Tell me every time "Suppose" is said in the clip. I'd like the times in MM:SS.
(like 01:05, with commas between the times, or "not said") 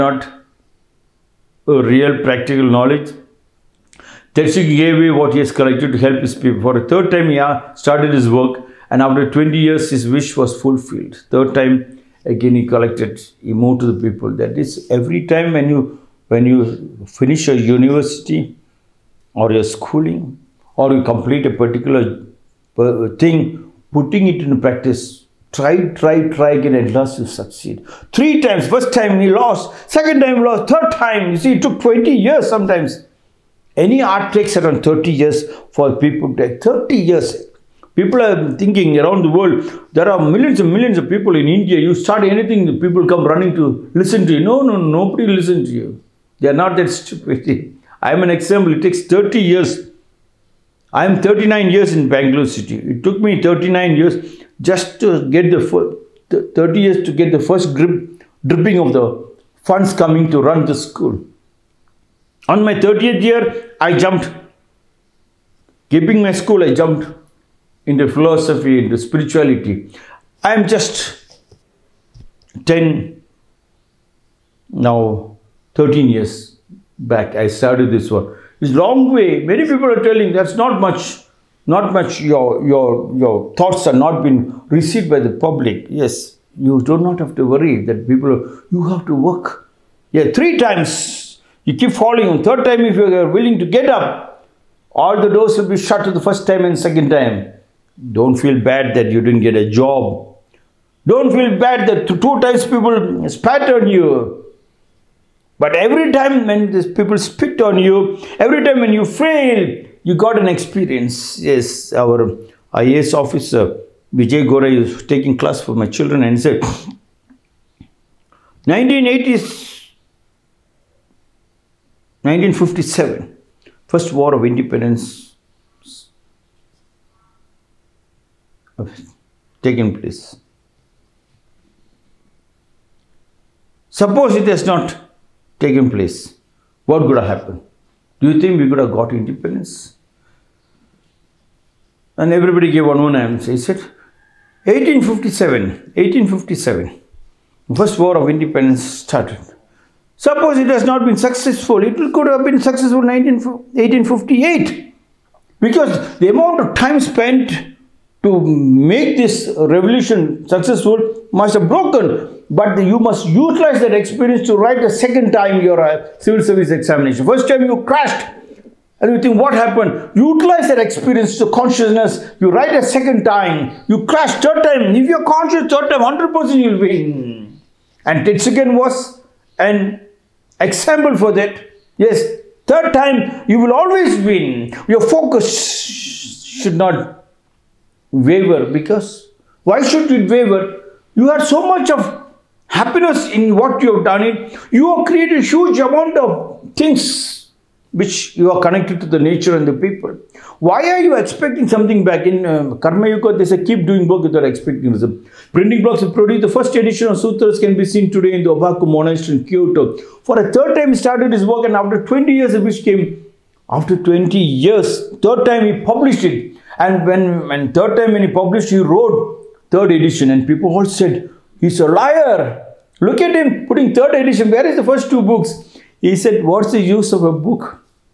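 02:13, 02:30.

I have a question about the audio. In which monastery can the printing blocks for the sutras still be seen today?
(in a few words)
Obaku Monastery.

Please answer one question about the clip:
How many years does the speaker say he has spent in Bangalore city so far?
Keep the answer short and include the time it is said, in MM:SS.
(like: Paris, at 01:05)
39, at 00:50.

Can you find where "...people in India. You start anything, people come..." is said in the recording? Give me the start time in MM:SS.
00:41.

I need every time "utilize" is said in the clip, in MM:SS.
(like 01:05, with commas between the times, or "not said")
02:43, 02:50.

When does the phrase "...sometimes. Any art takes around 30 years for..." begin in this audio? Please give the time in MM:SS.
00:32.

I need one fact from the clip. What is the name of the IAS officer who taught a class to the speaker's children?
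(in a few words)
Vijay Gorai.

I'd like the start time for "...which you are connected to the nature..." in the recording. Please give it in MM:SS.
03:17.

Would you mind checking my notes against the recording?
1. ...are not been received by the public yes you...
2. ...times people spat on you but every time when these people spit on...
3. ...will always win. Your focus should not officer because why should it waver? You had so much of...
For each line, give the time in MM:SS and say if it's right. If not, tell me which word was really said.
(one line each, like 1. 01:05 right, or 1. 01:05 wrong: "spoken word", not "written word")
1. 01:23 right
2. 01:42 right
3. 03:03 wrong: "waver", not "officer".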